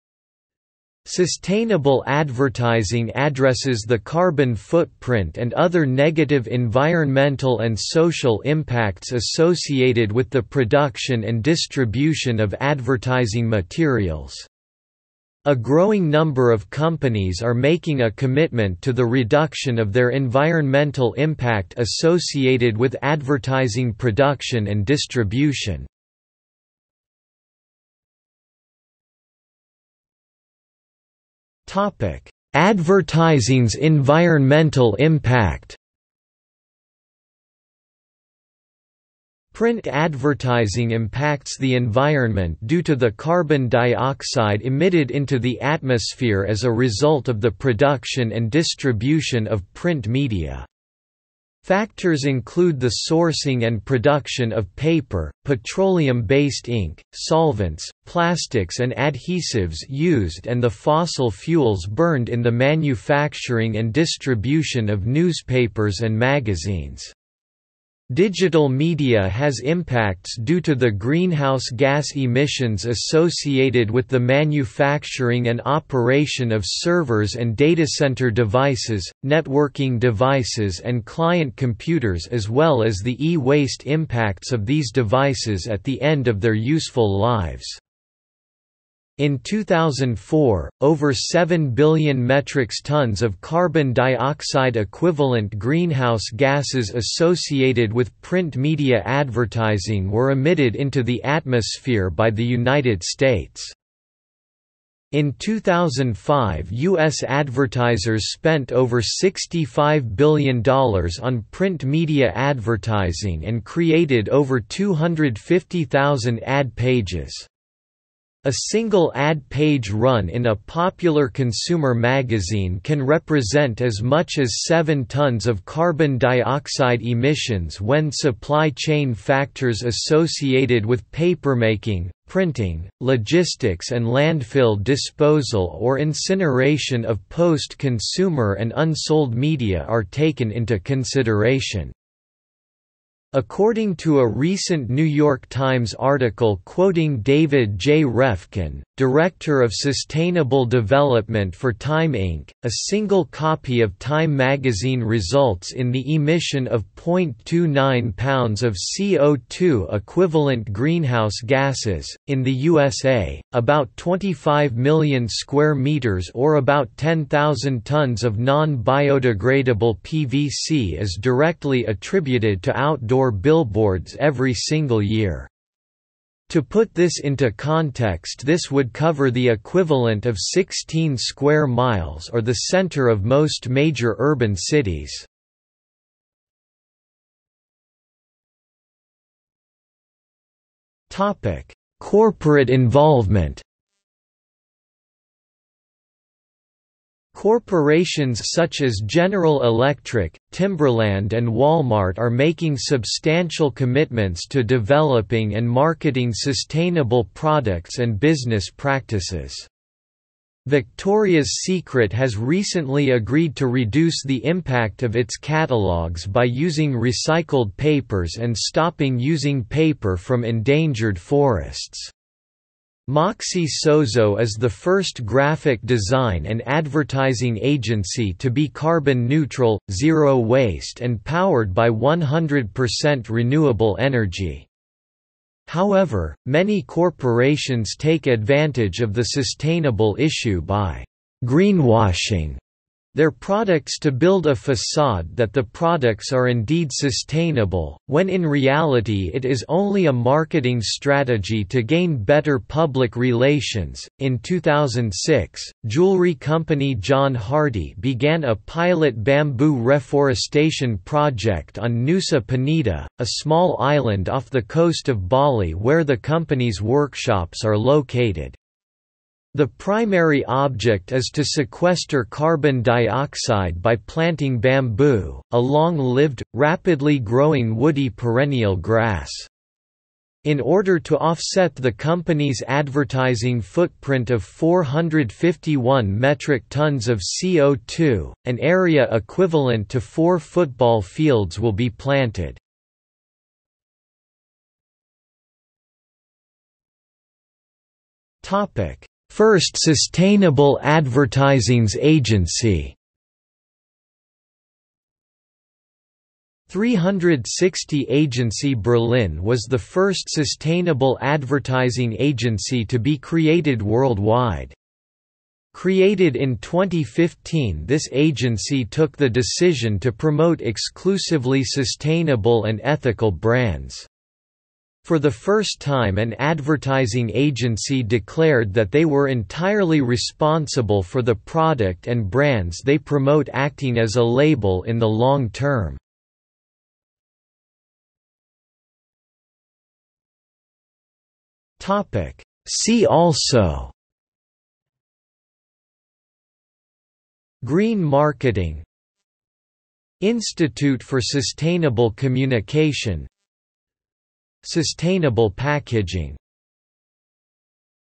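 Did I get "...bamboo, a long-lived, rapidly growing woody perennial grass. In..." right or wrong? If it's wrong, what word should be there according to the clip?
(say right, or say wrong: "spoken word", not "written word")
right.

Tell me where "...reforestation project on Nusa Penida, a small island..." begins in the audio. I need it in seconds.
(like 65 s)
259 s.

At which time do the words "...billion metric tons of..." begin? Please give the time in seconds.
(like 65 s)
91 s.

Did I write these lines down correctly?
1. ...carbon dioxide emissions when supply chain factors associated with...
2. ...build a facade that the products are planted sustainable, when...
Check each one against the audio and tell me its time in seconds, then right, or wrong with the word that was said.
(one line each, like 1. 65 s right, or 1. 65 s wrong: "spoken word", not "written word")
1. 125 s right
2. 244 s wrong: "indeed", not "planted".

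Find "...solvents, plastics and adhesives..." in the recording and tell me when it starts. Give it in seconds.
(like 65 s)
57 s.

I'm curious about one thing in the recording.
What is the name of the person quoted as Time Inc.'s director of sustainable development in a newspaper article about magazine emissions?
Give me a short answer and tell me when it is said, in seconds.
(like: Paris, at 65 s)
David J. Refkin, at 147 s.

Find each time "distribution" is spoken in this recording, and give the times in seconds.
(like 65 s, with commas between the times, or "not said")
11 s, 24 s, 48 s, 63 s.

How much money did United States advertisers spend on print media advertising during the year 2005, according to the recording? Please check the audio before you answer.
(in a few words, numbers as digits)
over $65 billion.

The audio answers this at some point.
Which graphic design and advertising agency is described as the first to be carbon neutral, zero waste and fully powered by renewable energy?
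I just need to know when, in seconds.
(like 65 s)
223 s.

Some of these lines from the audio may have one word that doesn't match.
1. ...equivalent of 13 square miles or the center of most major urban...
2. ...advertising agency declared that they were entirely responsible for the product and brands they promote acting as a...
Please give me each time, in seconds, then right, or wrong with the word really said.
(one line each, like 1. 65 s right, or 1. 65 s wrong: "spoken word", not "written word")
1. 179 s wrong: "16", not "13"
2. 326 s right.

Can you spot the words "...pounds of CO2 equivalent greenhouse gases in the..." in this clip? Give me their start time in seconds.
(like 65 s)
158 s.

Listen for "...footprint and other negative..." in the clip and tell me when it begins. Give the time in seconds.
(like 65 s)
4 s.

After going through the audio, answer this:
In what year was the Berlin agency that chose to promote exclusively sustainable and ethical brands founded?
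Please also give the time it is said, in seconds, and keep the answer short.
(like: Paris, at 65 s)
2015, at 316 s.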